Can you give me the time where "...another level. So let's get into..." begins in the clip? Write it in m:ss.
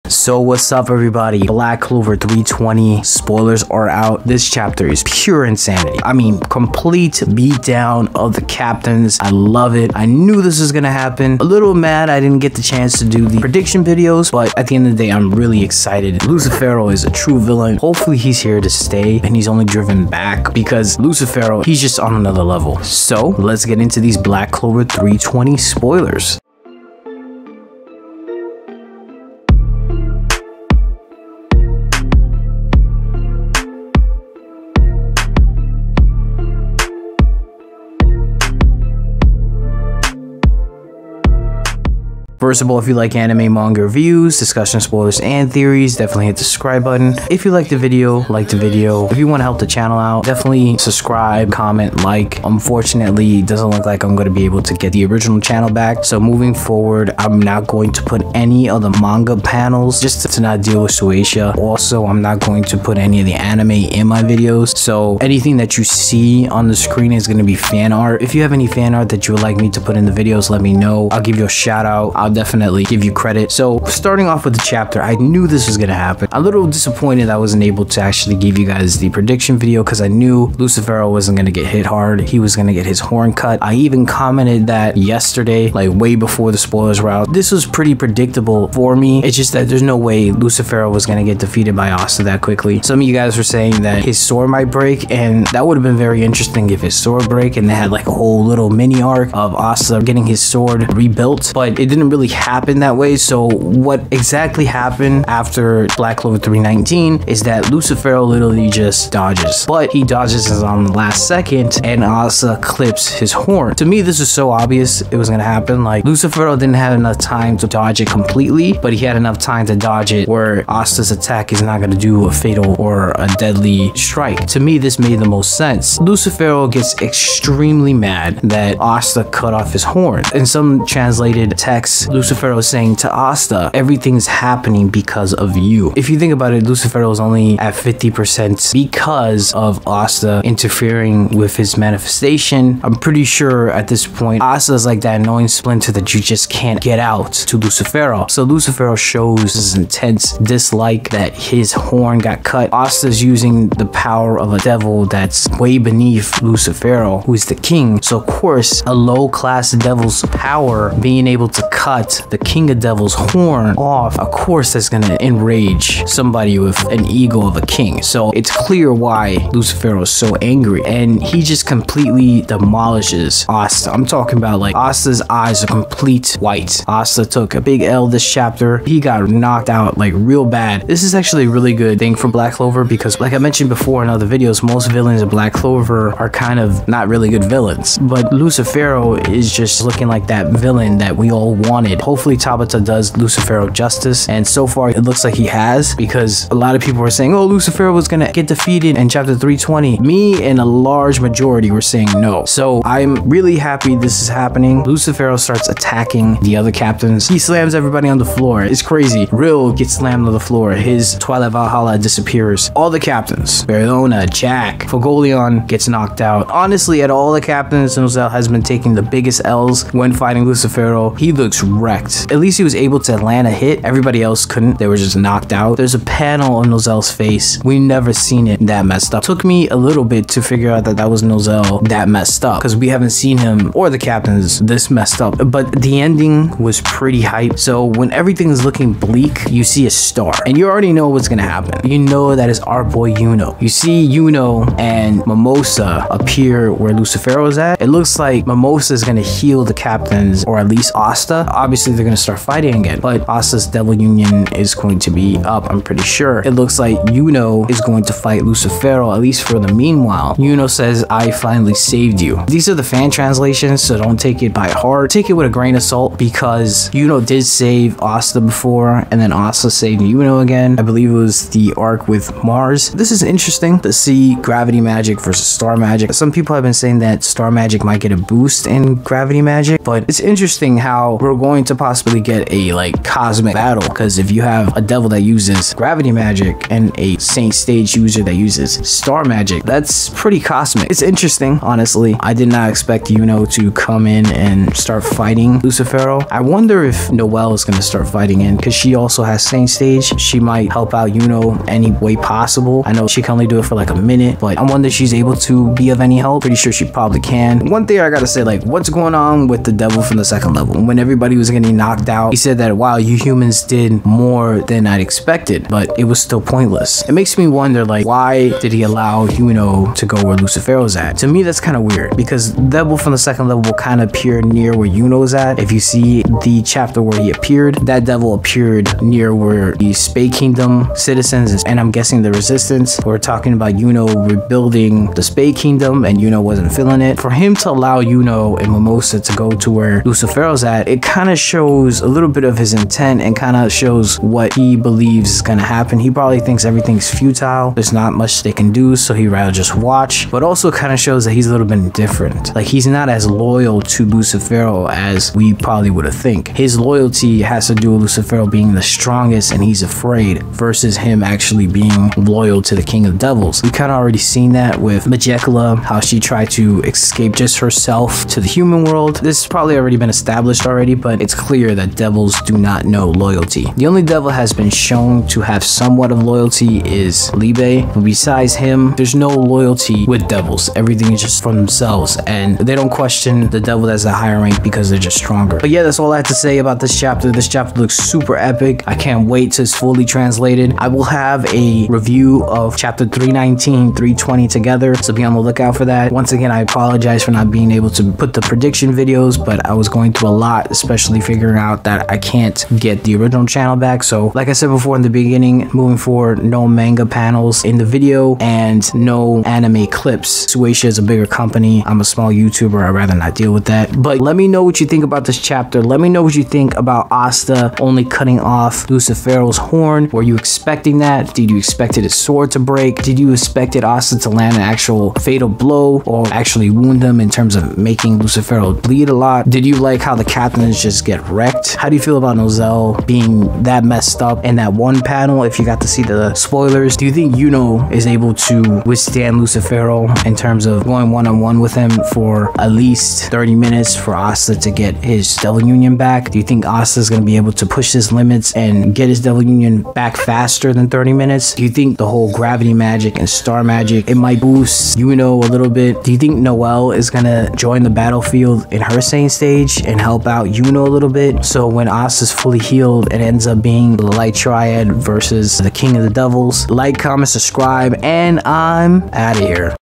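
0:22.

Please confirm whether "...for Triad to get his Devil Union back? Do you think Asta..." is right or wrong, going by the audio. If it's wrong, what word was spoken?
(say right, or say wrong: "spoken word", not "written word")
wrong: "Asta", not "Triad".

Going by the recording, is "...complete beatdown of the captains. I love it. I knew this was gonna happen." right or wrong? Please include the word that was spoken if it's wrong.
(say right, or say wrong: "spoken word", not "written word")
right.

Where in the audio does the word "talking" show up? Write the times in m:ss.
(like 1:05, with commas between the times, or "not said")
2:54, 5:33.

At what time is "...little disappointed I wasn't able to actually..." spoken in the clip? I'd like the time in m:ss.
1:16.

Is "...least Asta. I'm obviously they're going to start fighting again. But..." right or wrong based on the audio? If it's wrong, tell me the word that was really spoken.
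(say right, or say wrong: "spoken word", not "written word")
right.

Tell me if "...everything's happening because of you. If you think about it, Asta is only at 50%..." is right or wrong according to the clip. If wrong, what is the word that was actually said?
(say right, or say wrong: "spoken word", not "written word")
wrong: "Lucifero", not "Asta".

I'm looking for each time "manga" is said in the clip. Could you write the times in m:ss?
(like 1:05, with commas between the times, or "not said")
0:43, 0:59, 6:46.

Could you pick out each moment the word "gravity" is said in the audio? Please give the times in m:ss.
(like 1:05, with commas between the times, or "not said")
4:34, 4:38, 4:45, 7:32.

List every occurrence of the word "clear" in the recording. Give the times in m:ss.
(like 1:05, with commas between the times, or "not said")
2:48, 6:11.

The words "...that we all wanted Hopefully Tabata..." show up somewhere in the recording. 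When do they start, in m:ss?
3:10.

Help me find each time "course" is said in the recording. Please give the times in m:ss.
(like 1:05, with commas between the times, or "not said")
2:38, 2:44.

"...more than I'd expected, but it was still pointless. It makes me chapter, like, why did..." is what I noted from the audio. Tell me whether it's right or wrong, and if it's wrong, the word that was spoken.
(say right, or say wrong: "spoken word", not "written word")
wrong: "wonder", not "chapter".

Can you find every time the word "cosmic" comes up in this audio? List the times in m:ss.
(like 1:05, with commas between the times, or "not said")
4:43, 4:50.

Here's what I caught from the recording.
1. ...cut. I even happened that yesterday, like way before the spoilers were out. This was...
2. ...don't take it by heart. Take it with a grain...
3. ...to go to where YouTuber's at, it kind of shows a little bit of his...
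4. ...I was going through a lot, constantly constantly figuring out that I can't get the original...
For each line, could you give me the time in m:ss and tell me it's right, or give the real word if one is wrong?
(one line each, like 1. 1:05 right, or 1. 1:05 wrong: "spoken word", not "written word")
1. 1:23 wrong: "commented", not "happened"
2. 4:23 right
3. 5:39 wrong: "Lucifero", not "YouTuber"
4. 6:39 wrong: "especially", not "constantly".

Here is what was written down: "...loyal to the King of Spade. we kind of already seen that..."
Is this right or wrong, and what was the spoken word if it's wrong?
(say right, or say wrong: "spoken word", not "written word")
wrong: "Devils", not "Spade".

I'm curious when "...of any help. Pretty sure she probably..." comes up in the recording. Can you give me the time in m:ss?
5:05.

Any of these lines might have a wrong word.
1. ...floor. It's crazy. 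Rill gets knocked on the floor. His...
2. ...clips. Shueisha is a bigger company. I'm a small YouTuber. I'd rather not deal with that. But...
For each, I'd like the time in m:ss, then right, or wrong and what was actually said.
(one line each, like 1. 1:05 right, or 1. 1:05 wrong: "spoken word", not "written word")
1. 3:28 wrong: "slammed", not "knocked"
2. 6:49 right.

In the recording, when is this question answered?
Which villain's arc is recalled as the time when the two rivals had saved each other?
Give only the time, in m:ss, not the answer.
4:32.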